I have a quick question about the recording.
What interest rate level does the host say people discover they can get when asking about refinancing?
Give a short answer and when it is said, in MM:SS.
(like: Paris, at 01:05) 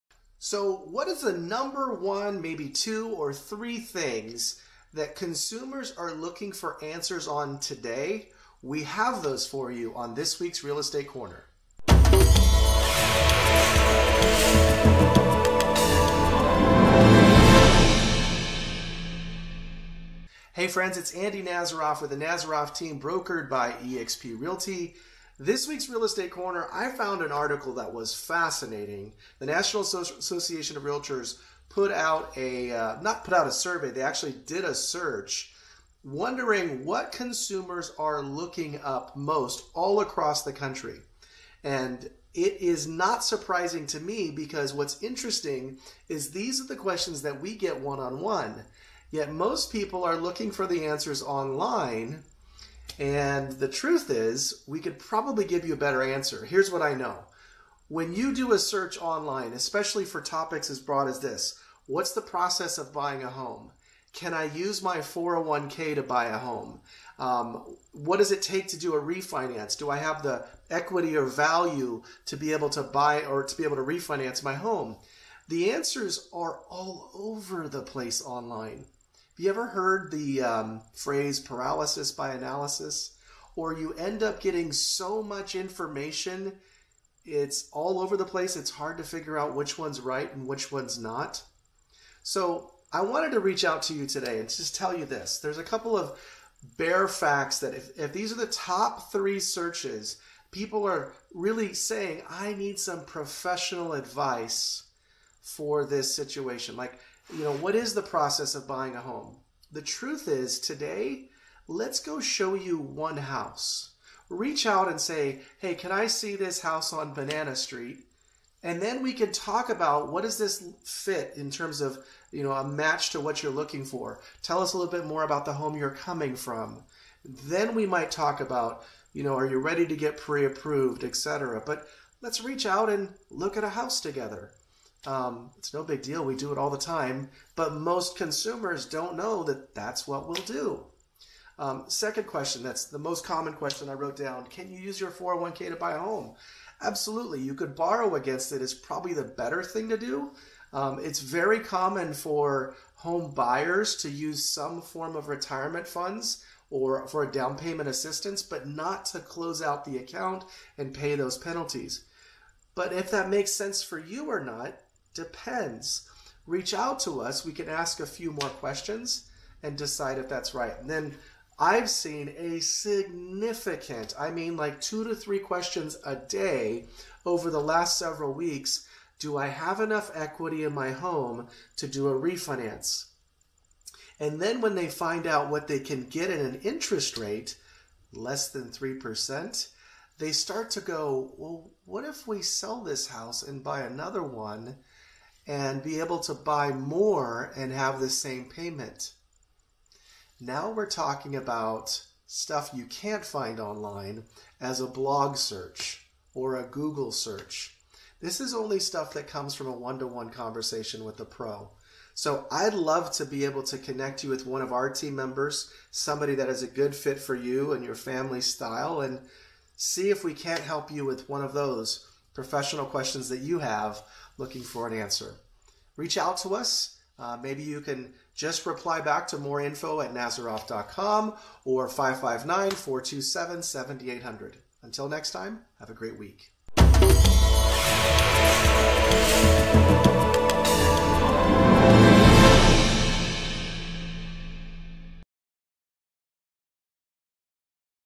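less than 3%, at 03:08.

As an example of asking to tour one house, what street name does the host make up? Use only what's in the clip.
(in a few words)
Banana Street.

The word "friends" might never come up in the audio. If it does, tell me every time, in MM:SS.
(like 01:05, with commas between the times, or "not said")
00:20.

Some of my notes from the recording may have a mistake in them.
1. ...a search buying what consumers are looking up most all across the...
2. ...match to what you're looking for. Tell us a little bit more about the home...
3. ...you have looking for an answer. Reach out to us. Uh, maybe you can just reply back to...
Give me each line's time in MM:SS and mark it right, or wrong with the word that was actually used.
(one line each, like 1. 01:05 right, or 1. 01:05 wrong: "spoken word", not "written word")
1. 00:34 wrong: "wondering", not "buying"
2. 02:02 right
3. 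03:43 right.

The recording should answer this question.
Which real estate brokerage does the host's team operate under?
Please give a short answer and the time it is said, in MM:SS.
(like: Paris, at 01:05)
eXp Realty, at 00:23.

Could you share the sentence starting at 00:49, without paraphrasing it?
Yet most people are looking for the answers online and the truth is, we could probably give you a better answer.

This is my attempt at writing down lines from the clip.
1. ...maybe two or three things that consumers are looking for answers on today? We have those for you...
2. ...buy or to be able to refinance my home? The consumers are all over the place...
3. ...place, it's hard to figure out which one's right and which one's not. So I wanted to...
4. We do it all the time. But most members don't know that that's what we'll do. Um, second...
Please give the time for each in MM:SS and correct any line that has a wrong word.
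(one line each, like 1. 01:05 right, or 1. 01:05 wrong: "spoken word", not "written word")
1. 00:02 right
2. 01:12 wrong: "answers", not "consumers"
3. 01:28 right
4. 02:16 wrong: "consumers", not "members".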